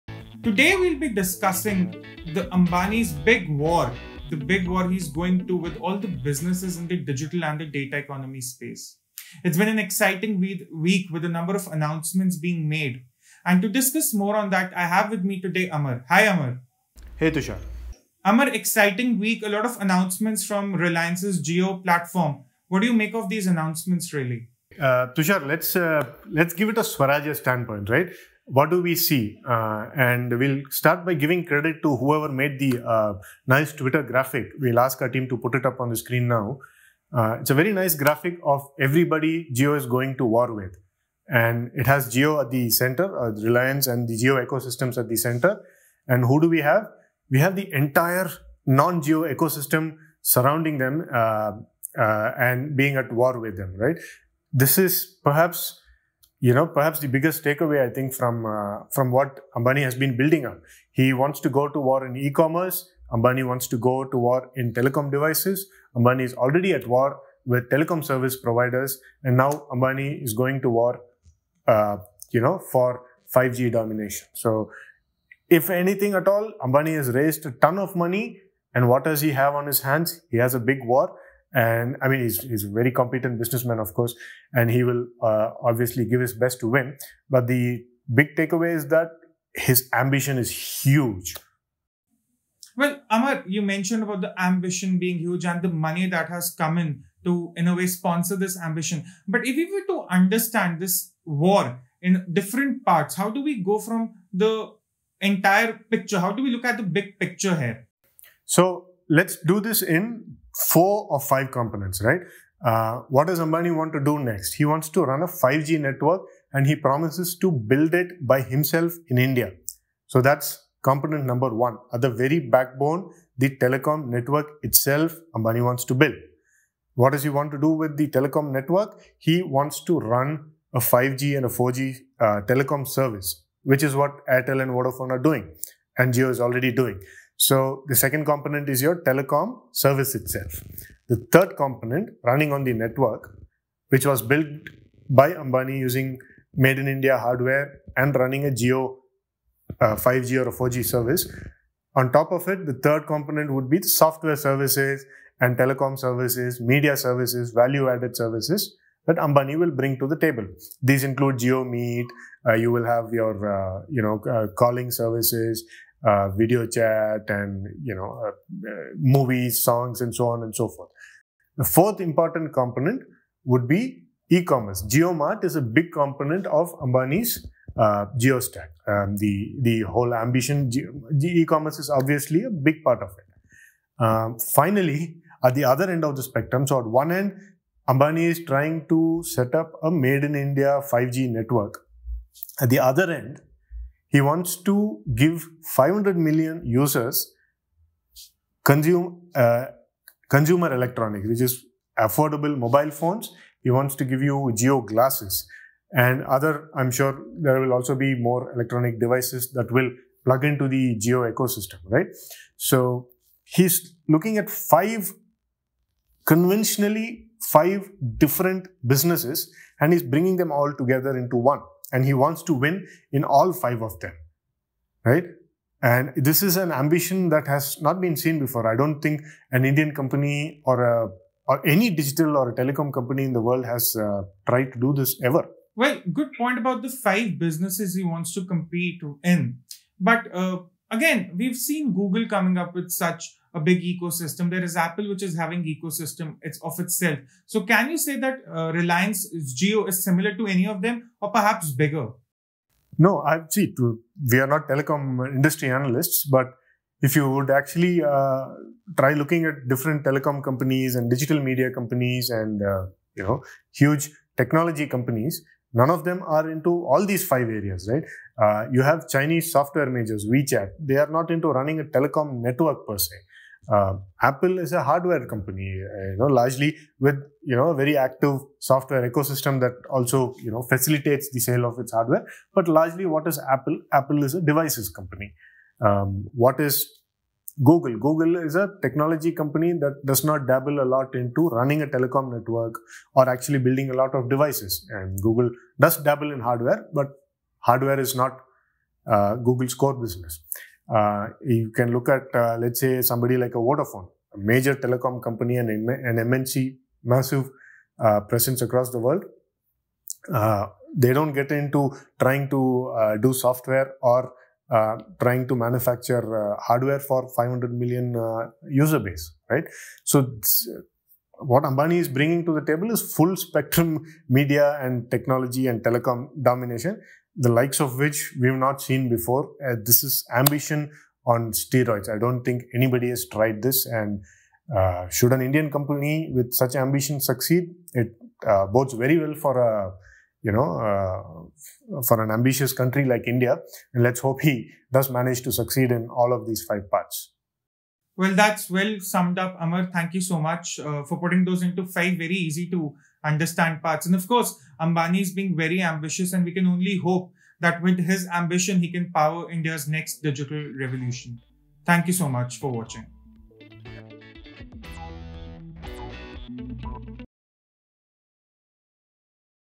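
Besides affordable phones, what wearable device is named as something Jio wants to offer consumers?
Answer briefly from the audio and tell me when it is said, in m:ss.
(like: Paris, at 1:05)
Jio glasses, at 3:24.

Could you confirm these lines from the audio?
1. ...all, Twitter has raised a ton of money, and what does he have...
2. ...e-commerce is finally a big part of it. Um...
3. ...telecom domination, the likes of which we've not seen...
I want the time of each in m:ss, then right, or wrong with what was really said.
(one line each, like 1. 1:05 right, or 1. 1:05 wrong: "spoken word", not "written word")
1. 1:16 wrong: "Ambani", not "Twitter"
2. 3:01 wrong: "obviously", not "finally"
3. 5:25 right.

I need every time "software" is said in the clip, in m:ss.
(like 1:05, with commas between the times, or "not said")
2:33, 4:29, 4:38, 5:13.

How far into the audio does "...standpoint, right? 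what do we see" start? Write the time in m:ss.
0:27.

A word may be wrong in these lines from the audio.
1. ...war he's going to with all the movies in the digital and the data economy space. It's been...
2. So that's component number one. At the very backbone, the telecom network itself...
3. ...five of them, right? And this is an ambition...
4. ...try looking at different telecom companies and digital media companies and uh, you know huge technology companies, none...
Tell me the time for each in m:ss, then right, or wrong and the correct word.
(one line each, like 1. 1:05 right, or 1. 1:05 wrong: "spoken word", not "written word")
1. 0:04 wrong: "businesses", not "movies"
2. 2:00 right
3. 3:43 right
4. 4:18 right.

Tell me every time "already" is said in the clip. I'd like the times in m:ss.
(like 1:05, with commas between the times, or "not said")
1:06, 2:16.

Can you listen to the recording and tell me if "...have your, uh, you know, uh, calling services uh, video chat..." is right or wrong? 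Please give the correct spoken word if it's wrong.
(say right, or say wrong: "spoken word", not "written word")
right.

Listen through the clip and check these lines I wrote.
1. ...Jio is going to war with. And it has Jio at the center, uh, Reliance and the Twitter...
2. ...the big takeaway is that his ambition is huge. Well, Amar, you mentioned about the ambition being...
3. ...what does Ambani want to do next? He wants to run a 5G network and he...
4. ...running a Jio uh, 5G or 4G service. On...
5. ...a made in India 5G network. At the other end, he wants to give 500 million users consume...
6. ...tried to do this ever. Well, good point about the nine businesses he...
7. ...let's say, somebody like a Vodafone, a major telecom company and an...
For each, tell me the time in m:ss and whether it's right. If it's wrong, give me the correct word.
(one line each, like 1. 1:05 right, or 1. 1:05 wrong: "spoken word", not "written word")
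1. 0:39 wrong: "Jio", not "Twitter"
2. 1:27 right
3. 1:53 right
4. 2:28 right
5. 3:09 right
6. 3:54 wrong: "five", not "nine"
7. 5:02 right.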